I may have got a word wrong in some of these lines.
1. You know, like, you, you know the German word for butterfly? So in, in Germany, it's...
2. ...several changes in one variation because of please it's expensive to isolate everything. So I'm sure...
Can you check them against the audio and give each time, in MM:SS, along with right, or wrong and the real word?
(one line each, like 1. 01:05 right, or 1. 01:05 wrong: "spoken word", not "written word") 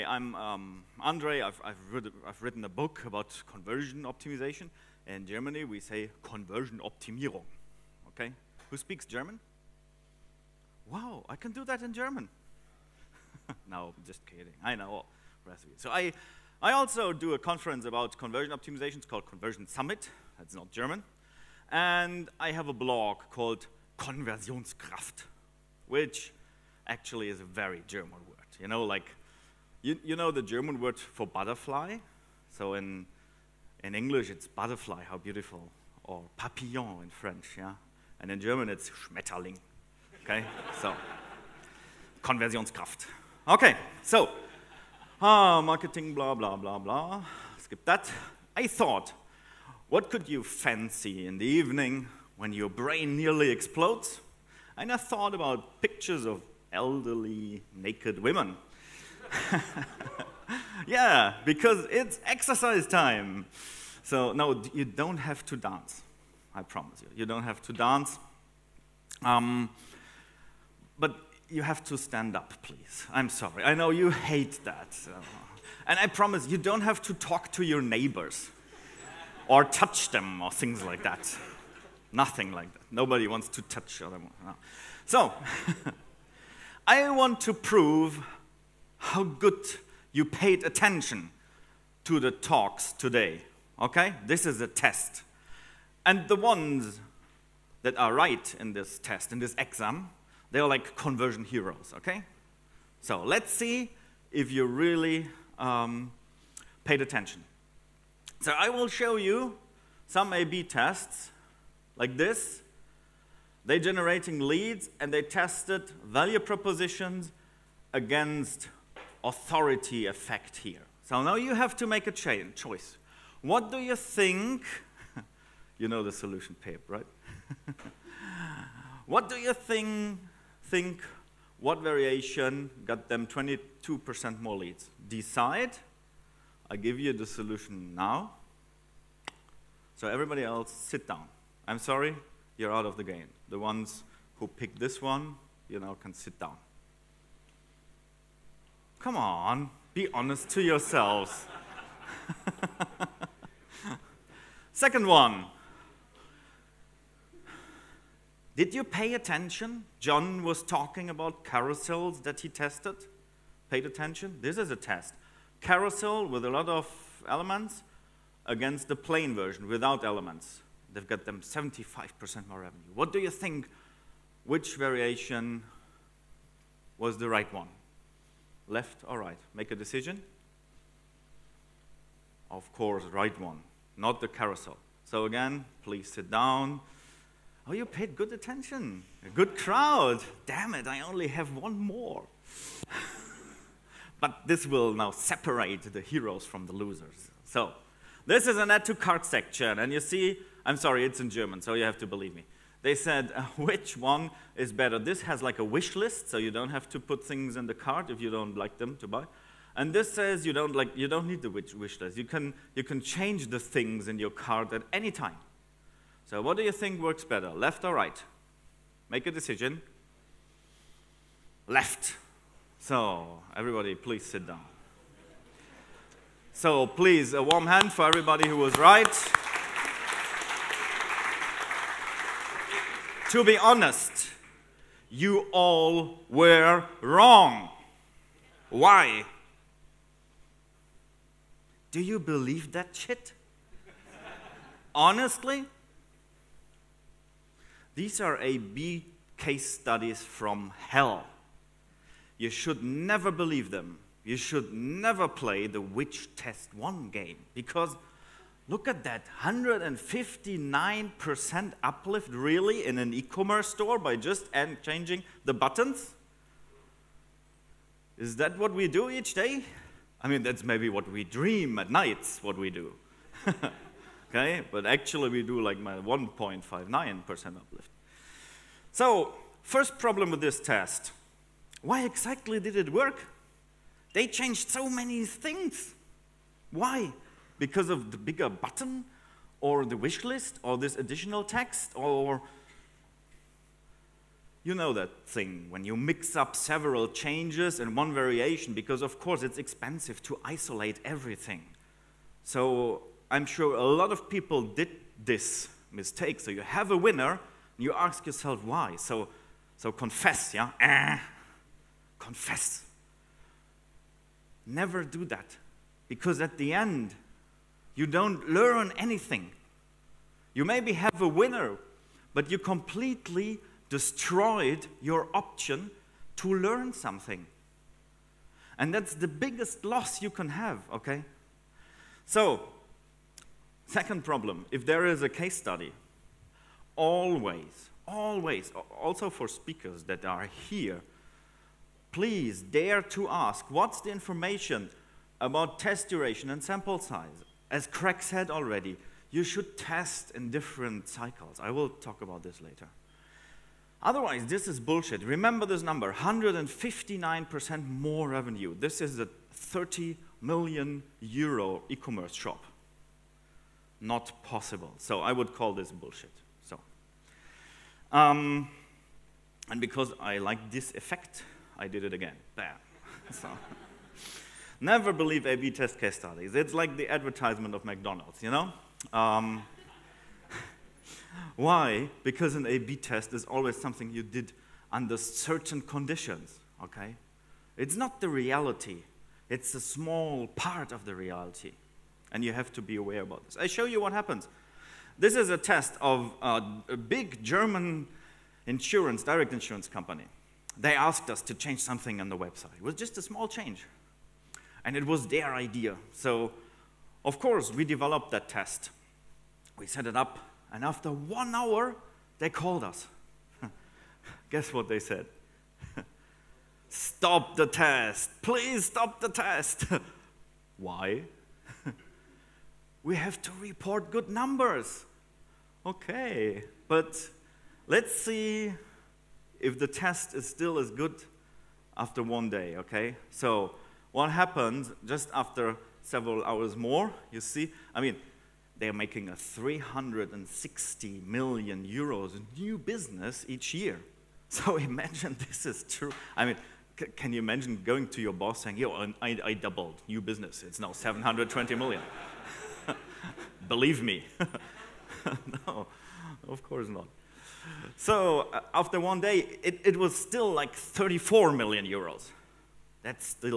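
1. 00:28 wrong: "English", not "Germany"
2. 04:56 wrong: "course", not "please".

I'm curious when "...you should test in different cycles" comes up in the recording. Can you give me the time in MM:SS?
05:49.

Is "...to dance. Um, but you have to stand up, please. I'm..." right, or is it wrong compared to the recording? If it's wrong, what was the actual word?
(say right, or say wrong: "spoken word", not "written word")
right.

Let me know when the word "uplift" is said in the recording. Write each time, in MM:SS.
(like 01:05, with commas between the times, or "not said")
04:21, 04:37.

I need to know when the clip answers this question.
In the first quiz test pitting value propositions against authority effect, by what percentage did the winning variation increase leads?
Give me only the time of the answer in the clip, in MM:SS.
02:13.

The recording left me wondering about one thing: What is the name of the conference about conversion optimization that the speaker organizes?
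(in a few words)
Conversion Summit.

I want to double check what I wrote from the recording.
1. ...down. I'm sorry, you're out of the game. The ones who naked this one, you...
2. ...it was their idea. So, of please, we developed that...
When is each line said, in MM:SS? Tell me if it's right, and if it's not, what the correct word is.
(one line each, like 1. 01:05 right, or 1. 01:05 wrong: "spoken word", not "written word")
1. 02:21 wrong: "picked", not "naked"
2. 06:44 wrong: "course", not "please".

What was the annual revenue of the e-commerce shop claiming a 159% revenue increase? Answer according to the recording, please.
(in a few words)
30 million euros.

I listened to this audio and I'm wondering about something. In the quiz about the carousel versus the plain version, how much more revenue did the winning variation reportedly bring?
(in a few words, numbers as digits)
75%.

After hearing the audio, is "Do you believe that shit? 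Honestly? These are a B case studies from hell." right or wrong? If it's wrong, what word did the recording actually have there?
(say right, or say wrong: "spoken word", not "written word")
right.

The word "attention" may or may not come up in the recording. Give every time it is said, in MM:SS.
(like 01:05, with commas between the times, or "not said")
01:30, 01:47, 02:39, 02:43, 03:08.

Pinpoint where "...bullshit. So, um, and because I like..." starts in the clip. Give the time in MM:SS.
06:05.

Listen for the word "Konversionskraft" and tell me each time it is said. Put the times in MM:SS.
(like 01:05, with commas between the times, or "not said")
00:23, 00:42.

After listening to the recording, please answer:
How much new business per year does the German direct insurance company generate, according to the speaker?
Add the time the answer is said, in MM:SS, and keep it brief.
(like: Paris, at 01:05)
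360 million euros, at 07:19.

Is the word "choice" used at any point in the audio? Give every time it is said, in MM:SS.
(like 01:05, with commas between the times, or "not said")
02:02.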